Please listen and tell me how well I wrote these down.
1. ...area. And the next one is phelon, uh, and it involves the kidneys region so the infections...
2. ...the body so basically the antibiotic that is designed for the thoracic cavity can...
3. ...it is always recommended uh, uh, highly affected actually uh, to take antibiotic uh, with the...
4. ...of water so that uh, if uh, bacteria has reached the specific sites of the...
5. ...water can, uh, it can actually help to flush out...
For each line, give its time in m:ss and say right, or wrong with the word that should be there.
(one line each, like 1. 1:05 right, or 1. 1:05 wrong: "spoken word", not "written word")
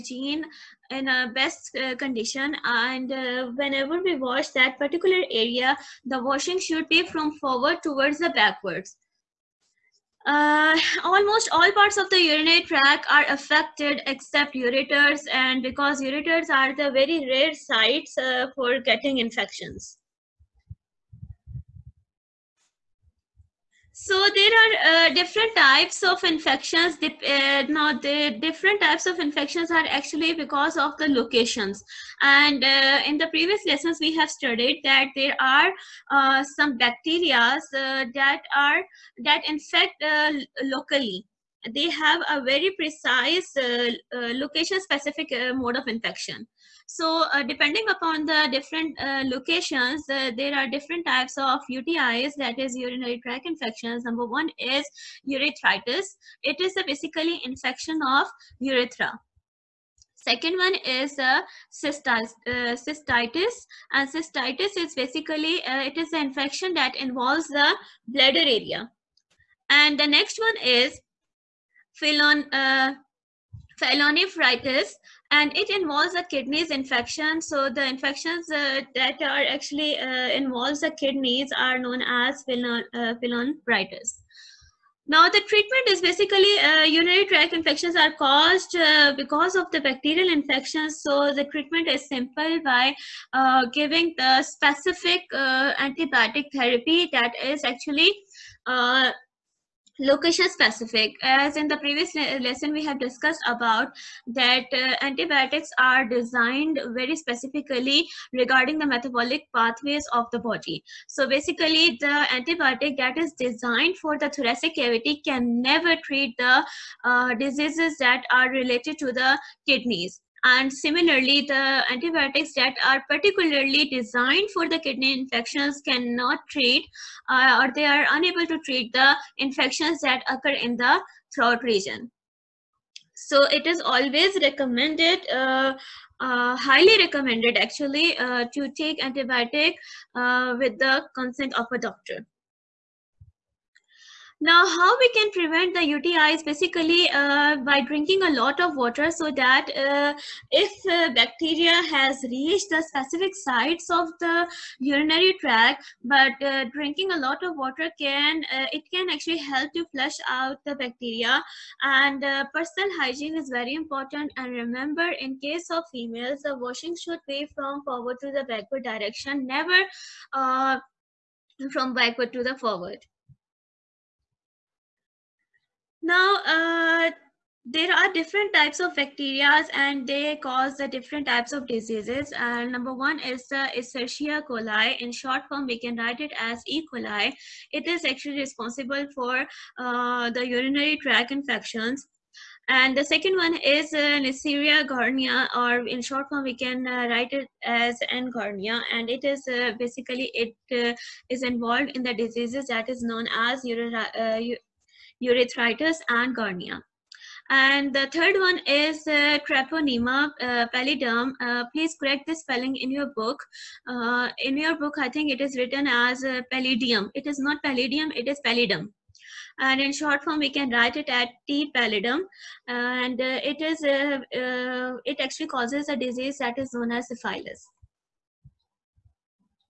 1. 1:08 wrong: "infection", not "region"
2. 1:50 right
3. 2:13 wrong: "recommended", not "affected"
4. 2:28 right
5. 2:37 right.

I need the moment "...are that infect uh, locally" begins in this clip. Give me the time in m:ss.
0:38.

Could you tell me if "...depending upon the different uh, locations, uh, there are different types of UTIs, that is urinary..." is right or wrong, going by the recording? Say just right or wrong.
right.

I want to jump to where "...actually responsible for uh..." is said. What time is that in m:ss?
3:08.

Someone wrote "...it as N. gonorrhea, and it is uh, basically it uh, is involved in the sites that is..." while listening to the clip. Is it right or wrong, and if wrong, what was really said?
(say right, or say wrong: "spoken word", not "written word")
wrong: "diseases", not "sites".